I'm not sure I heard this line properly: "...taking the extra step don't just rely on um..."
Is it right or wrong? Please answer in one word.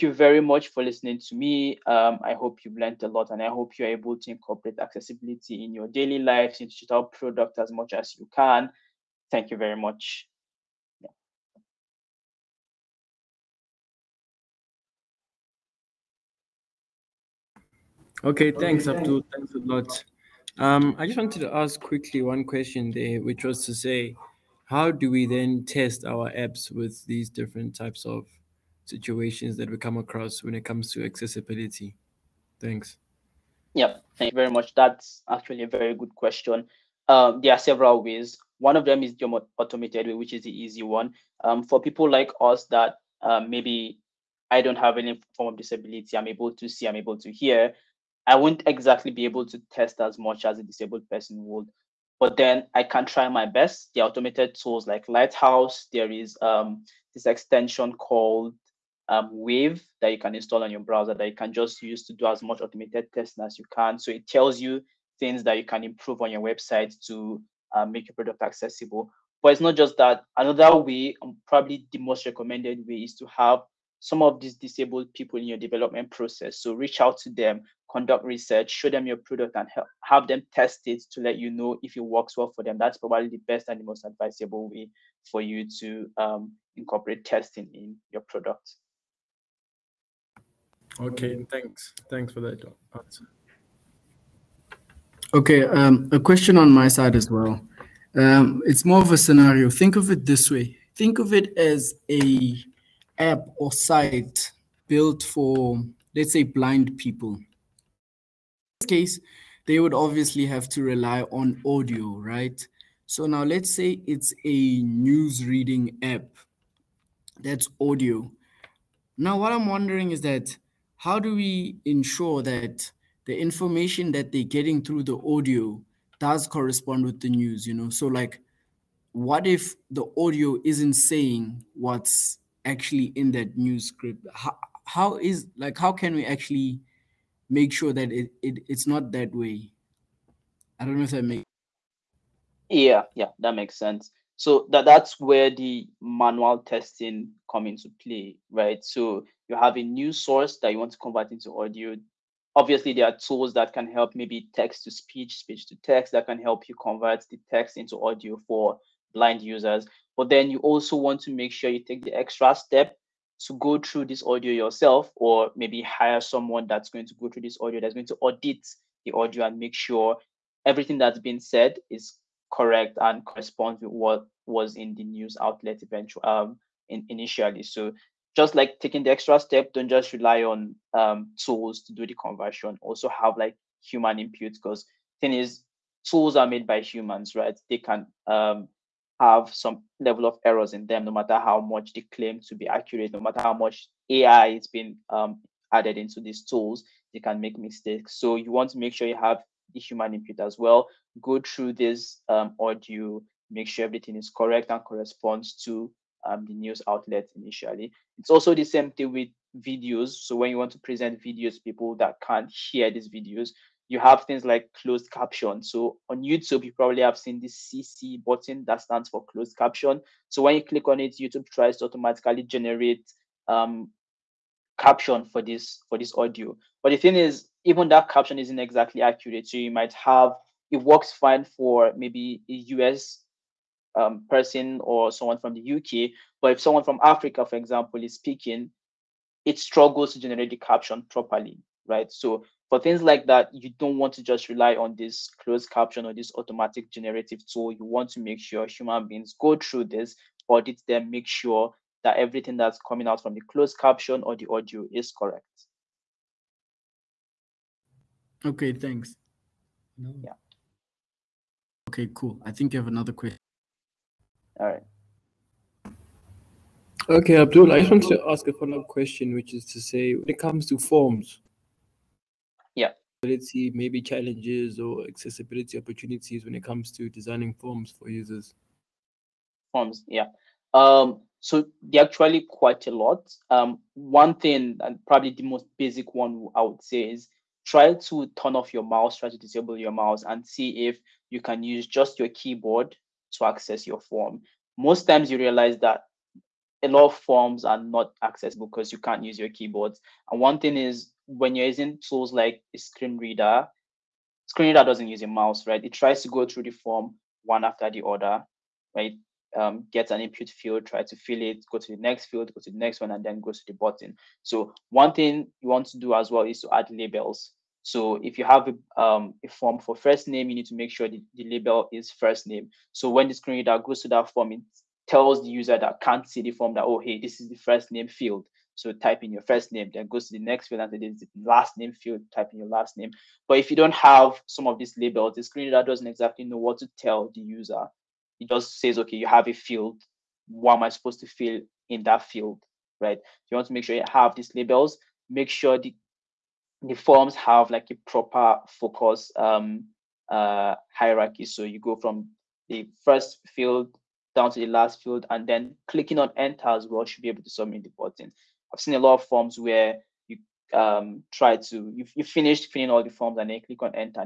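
right.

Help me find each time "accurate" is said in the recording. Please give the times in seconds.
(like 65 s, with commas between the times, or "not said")
192 s, 229 s.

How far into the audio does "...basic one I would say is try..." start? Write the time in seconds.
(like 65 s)
285 s.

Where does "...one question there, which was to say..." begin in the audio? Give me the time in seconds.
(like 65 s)
22 s.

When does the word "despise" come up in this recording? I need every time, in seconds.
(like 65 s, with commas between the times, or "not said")
not said.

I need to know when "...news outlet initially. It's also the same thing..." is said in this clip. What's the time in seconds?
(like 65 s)
206 s.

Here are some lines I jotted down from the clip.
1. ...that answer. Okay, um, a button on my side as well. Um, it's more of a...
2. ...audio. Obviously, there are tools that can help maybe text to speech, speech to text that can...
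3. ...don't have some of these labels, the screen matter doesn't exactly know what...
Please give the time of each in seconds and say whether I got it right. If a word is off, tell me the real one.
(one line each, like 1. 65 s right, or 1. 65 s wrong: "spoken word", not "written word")
1. 92 s wrong: "question", not "button"
2. 151 s right
3. 333 s wrong: "reader", not "matter".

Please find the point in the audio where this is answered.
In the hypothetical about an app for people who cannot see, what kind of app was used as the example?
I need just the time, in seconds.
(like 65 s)
114 s.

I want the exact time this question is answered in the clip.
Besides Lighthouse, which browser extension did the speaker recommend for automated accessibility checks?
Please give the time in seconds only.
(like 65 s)
59 s.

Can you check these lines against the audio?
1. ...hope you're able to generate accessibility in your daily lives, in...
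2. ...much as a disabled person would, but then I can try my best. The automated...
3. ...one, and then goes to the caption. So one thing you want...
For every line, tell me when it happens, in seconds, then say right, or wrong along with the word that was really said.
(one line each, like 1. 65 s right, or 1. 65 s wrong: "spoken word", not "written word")
1. 3 s wrong: "incorporate", not "generate"
2. 50 s right
3. 313 s wrong: "button", not "caption".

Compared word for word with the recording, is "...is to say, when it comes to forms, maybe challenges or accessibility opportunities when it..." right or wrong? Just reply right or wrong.
right.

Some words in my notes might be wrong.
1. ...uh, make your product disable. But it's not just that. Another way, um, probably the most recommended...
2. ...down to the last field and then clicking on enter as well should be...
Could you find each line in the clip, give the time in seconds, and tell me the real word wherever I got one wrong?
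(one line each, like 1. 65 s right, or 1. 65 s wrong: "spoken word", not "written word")
1. 67 s wrong: "accessible", not "disable"
2. 354 s right.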